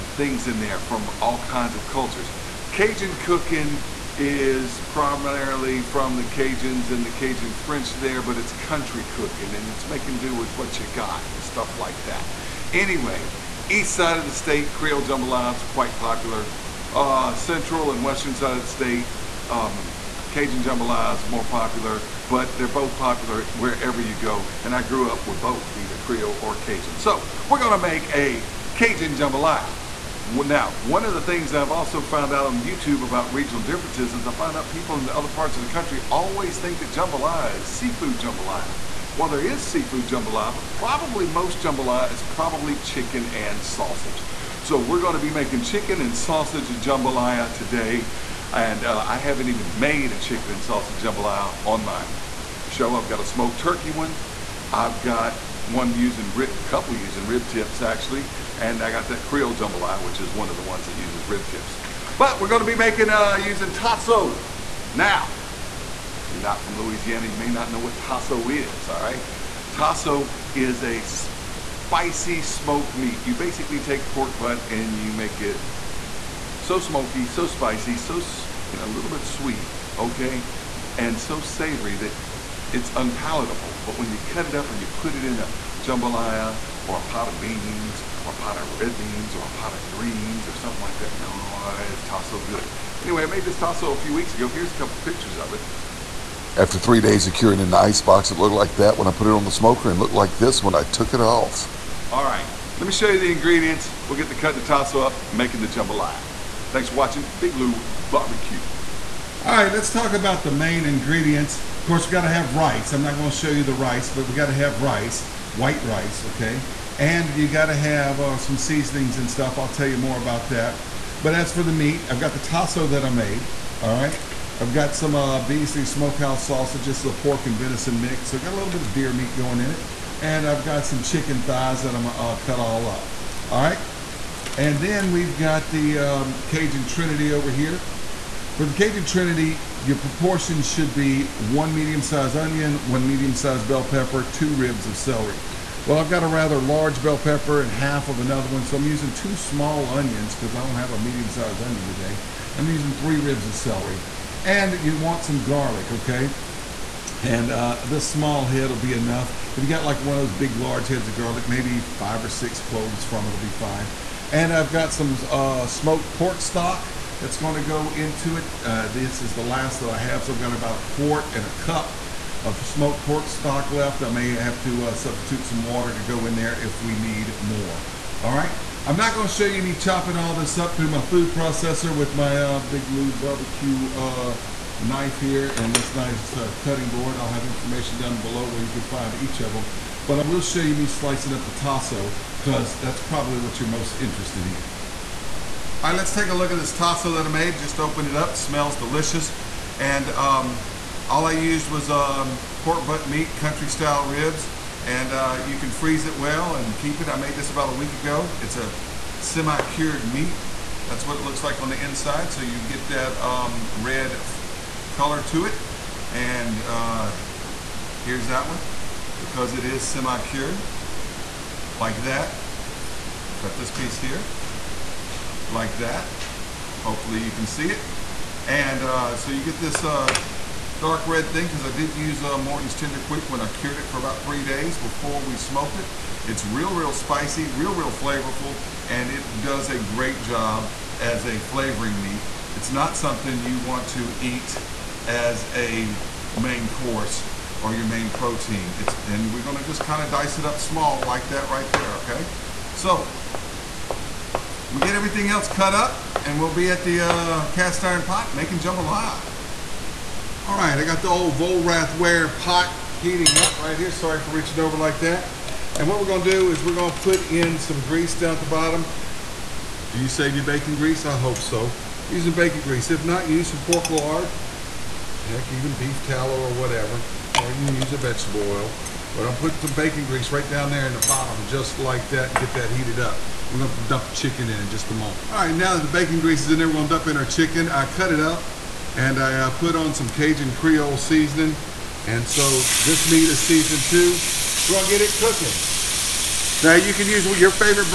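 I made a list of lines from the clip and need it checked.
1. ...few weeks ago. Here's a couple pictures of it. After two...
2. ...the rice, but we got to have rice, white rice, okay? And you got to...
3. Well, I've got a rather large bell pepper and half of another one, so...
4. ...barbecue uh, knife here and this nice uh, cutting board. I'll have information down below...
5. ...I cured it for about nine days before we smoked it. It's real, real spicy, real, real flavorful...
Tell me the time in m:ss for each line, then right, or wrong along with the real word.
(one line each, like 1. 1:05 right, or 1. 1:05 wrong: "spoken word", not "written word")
1. 1:33 wrong: "three", not "two"
2. 1:53 right
3. 2:25 right
4. 3:03 right
5. 3:53 wrong: "three", not "nine".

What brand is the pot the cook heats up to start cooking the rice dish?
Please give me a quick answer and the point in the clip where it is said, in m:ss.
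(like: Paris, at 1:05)
Vollrath, at 4:21.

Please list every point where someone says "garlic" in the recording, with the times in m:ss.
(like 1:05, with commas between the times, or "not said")
2:35, 2:41.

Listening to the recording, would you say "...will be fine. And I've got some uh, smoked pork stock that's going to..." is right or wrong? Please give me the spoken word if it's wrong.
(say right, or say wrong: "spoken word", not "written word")
right.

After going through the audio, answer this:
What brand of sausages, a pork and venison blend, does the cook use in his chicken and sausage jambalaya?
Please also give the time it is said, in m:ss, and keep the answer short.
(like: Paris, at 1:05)
Beasley Smokehouse, at 2:05.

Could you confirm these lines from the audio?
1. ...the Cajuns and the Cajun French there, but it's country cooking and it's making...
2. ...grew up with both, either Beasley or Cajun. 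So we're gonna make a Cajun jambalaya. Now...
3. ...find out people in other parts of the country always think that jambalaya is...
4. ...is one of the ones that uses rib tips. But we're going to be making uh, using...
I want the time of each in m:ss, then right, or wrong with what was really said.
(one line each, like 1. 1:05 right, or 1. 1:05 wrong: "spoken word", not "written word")
1. 0:06 right
2. 0:24 wrong: "Creole", not "Beasley"
3. 0:34 right
4. 1:00 right.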